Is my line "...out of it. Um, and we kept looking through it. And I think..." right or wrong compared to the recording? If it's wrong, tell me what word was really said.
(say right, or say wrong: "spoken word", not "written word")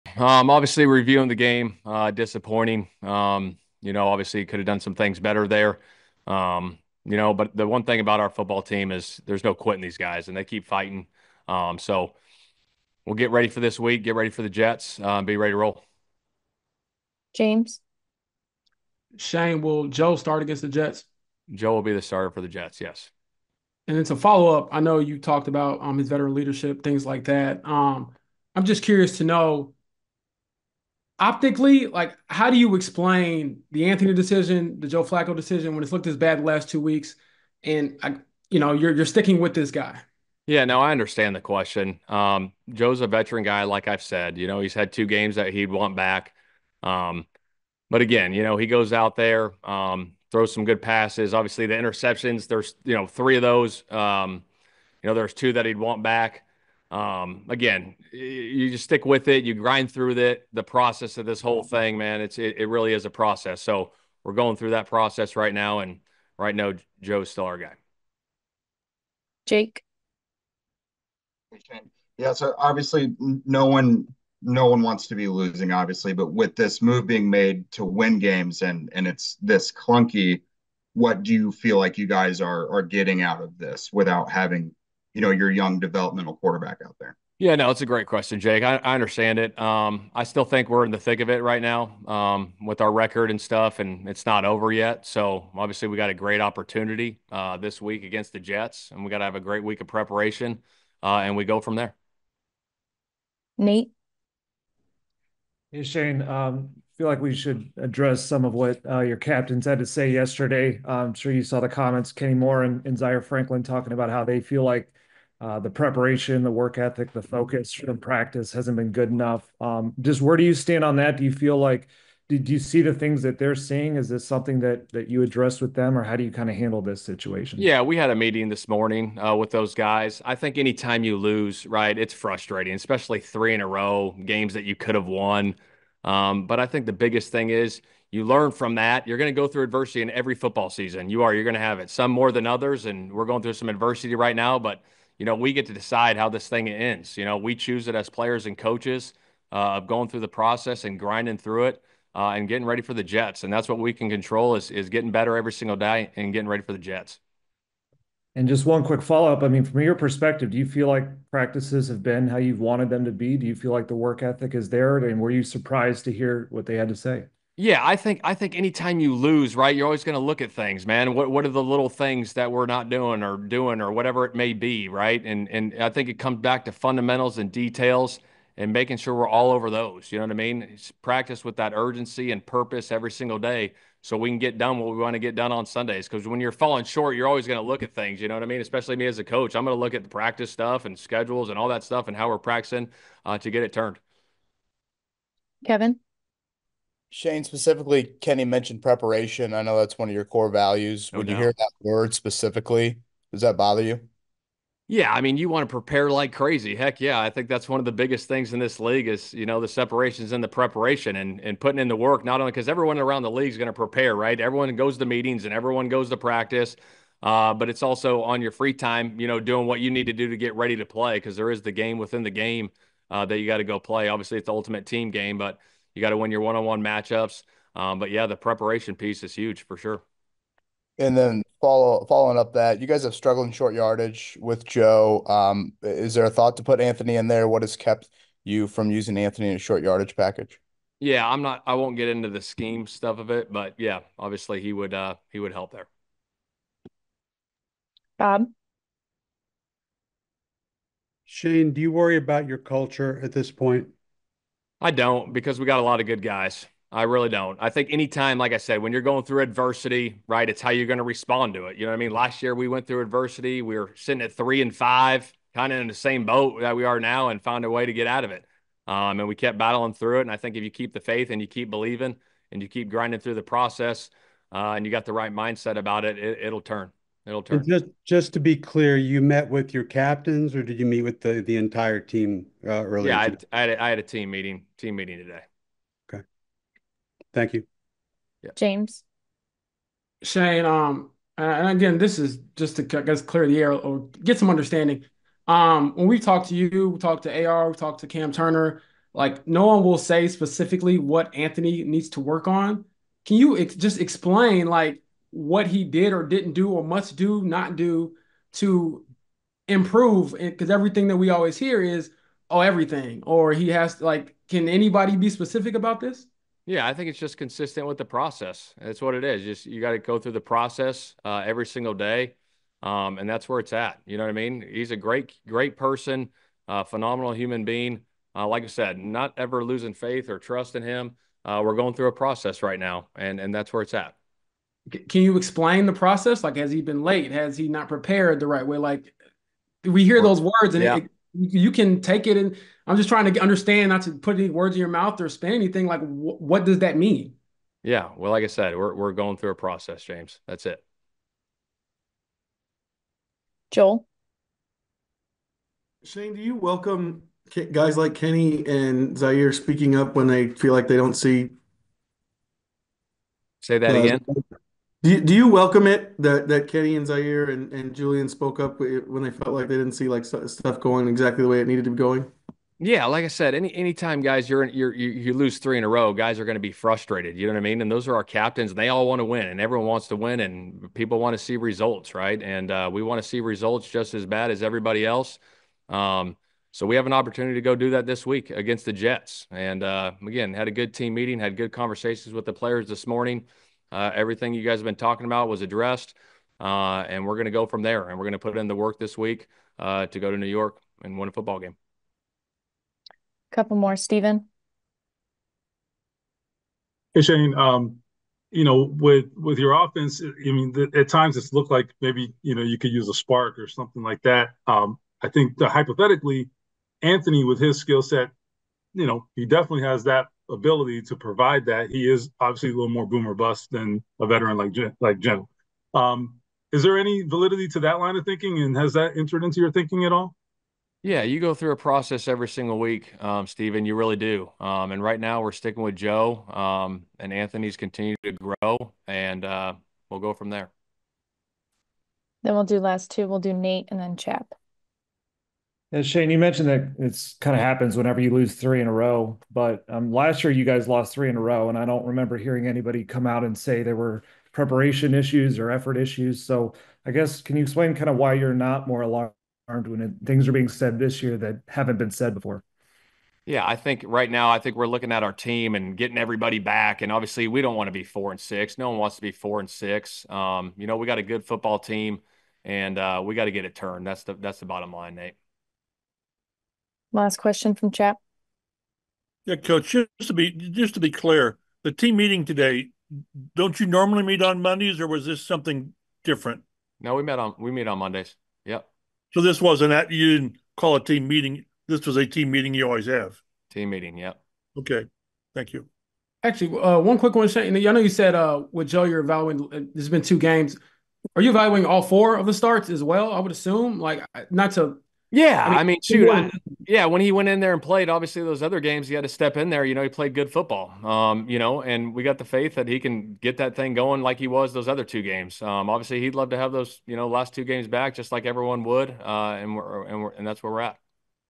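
wrong: "battling", not "looking".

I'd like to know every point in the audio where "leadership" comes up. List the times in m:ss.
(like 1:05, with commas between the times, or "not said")
0:26.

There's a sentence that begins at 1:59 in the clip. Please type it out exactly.
Um, just where do you stand on that?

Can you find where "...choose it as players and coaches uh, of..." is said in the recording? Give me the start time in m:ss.
2:27.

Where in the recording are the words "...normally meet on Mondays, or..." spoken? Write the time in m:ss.
8:03.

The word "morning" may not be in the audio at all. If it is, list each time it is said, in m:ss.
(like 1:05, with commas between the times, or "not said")
2:08, 6:33.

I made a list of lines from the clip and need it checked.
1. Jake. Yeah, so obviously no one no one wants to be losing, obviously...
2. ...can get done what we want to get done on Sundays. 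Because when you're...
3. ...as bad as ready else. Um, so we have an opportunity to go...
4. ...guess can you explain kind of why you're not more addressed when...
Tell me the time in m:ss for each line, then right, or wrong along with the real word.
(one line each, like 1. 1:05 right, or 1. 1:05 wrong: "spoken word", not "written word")
1. 1:09 right
2. 3:04 right
3. 6:24 wrong: "everybody", not "ready"
4. 7:37 wrong: "alarmed", not "addressed".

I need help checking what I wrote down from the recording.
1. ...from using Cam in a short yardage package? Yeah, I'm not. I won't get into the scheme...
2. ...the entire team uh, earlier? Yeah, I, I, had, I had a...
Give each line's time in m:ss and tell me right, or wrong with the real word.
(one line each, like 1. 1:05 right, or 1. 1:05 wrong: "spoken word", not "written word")
1. 3:58 wrong: "Anthony", not "Cam"
2. 4:41 right.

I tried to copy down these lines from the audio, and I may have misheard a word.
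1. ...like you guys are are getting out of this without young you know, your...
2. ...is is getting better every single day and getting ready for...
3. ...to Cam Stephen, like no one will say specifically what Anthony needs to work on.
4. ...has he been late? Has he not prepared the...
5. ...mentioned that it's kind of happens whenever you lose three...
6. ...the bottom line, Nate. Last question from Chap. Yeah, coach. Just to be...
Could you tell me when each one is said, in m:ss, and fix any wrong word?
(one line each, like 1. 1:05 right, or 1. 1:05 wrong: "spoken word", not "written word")
1. 1:21 wrong: "having", not "young"
2. 2:34 right
3. 4:57 wrong: "Turner", not "Stephen"
4. 5:36 right
5. 7:26 right
6. 7:54 right.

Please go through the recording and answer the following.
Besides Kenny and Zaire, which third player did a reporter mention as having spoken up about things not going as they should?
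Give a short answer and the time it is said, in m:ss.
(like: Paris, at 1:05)
Julian, at 6:07.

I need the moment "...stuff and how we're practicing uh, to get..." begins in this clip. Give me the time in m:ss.
3:11.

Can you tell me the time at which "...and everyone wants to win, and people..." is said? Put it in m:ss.
6:19.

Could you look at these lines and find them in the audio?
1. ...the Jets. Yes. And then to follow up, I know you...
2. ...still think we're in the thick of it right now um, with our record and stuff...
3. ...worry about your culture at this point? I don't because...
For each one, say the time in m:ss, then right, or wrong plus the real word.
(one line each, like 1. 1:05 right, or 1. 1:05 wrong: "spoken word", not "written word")
1. 0:22 right
2. 1:30 right
3. 4:11 right.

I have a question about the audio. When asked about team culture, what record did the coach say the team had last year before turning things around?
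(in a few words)
3-5.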